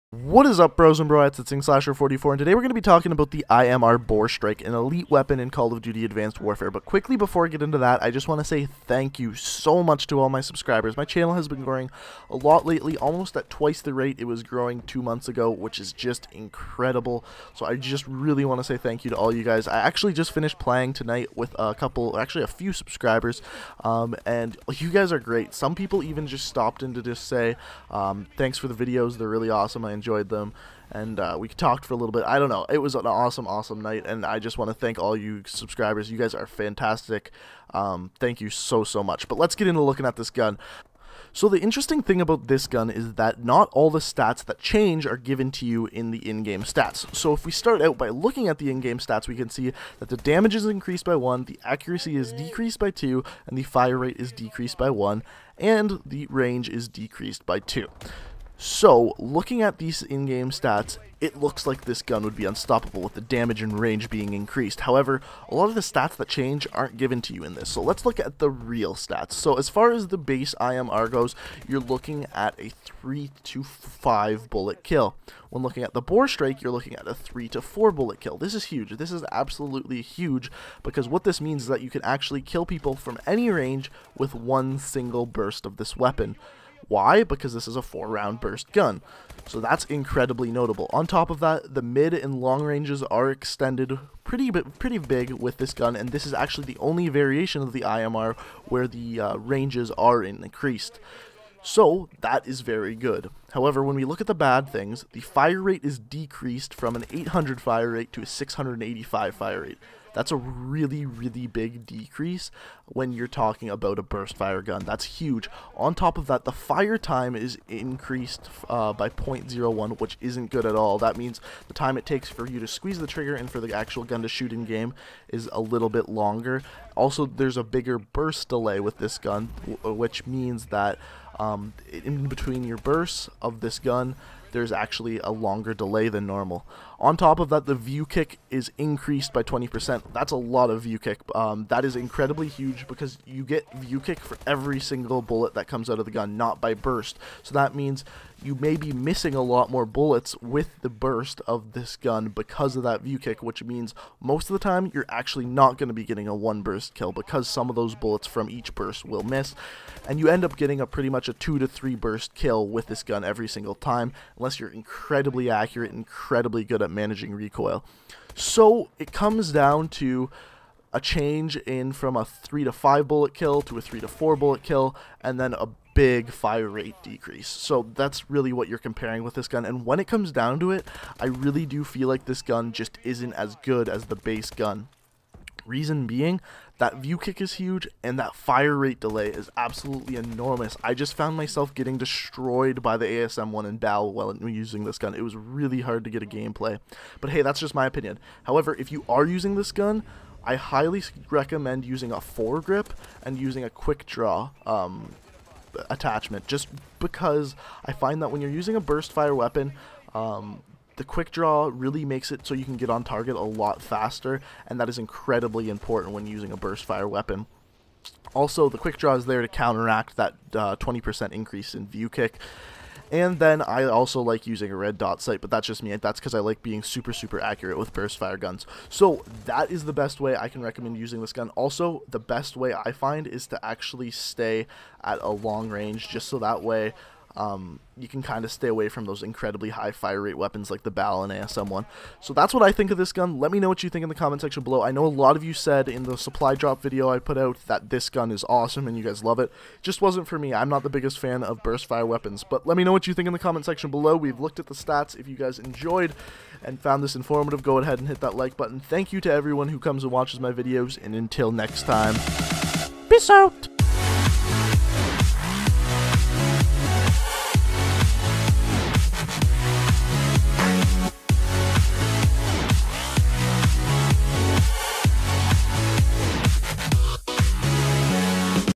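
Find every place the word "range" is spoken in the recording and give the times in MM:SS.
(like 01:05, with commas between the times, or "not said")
00:56, 01:03, 01:23, 01:32, 01:39, 03:55.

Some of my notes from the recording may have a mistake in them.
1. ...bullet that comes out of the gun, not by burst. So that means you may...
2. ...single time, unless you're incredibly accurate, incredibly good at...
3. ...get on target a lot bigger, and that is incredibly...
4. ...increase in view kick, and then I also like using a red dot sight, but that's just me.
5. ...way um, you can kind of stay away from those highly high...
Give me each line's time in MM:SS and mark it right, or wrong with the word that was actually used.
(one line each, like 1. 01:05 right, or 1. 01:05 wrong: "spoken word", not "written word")
1. 02:25 right
2. 02:43 right
3. 03:32 wrong: "faster", not "bigger"
4. 03:41 right
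5. 03:56 wrong: "incredibly", not "highly".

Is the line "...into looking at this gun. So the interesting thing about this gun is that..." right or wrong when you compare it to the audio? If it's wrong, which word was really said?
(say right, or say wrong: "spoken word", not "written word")
right.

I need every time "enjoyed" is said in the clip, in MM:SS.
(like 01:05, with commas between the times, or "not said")
00:30, 04:15.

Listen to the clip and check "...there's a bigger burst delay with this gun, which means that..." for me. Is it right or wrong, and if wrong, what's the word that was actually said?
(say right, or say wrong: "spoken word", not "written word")
right.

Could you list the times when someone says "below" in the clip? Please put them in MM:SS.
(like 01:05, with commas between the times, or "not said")
04:04, 04:13.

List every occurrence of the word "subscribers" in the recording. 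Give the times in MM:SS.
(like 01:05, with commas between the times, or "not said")
00:10, 00:22, 00:35.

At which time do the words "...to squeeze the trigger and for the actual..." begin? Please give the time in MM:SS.
02:02.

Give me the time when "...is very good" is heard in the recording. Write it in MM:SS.
01:42.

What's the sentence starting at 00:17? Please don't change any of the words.
So I just really want to say thank you to all you guys.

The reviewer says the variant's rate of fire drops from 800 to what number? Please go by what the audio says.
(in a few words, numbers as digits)
685.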